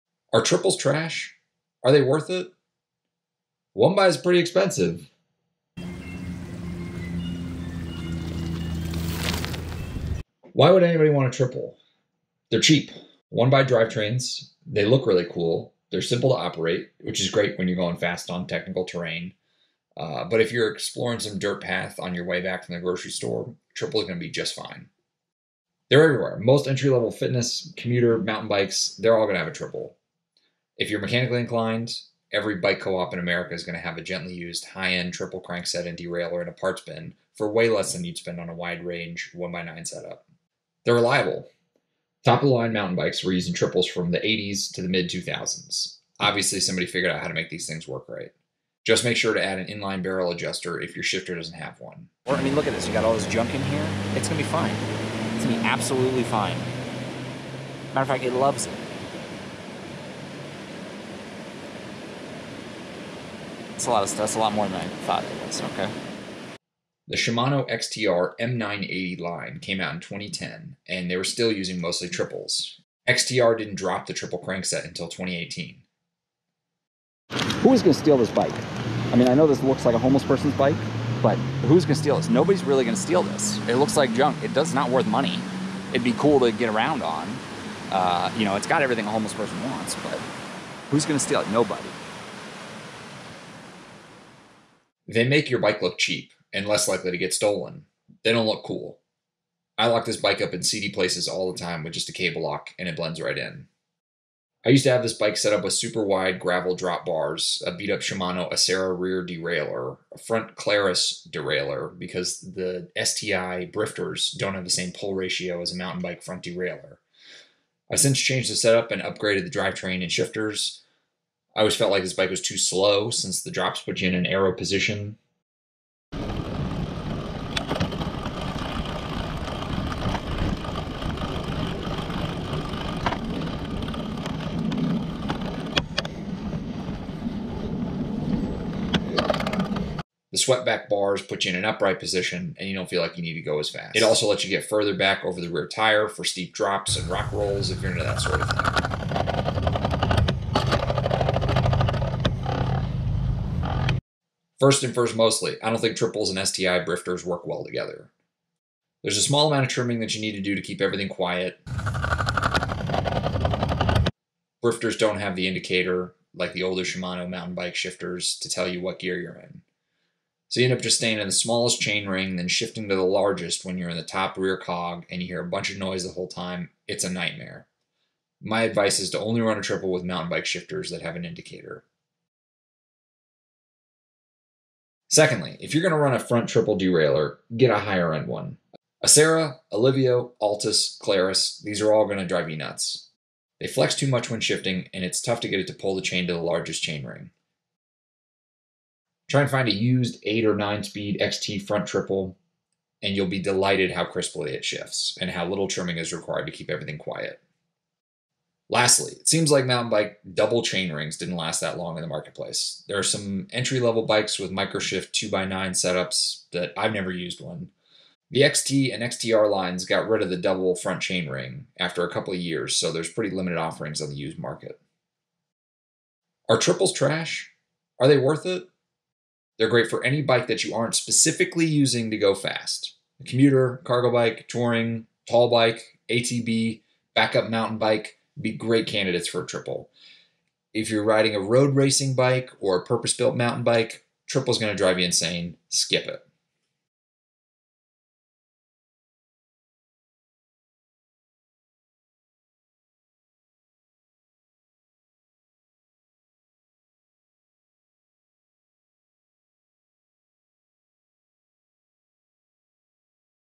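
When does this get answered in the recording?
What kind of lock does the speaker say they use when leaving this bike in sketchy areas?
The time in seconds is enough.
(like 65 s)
102 s.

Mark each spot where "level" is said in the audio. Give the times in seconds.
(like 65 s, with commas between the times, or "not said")
26 s, 213 s.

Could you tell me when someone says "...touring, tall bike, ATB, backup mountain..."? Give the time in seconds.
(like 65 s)
234 s.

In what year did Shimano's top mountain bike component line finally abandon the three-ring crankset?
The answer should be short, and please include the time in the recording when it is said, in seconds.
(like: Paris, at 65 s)
2018, at 75 s.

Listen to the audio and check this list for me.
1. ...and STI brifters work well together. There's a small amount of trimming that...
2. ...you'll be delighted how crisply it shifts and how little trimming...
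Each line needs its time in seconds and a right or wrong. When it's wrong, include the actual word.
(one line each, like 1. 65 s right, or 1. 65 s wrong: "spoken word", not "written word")
1. 156 s right
2. 203 s right.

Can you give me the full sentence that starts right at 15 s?
They're simple to operate, which is great when you're going fast on technical terrain.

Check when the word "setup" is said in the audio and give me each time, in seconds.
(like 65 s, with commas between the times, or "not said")
39 s, 118 s, 215 s.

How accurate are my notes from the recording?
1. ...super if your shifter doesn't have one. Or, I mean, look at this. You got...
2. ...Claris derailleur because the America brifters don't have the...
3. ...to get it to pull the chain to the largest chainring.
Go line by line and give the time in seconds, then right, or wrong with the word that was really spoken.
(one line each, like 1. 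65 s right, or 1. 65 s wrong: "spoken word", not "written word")
1. 50 s wrong: "adjuster", not "super"
2. 110 s wrong: "STI", not "America"
3. 195 s right.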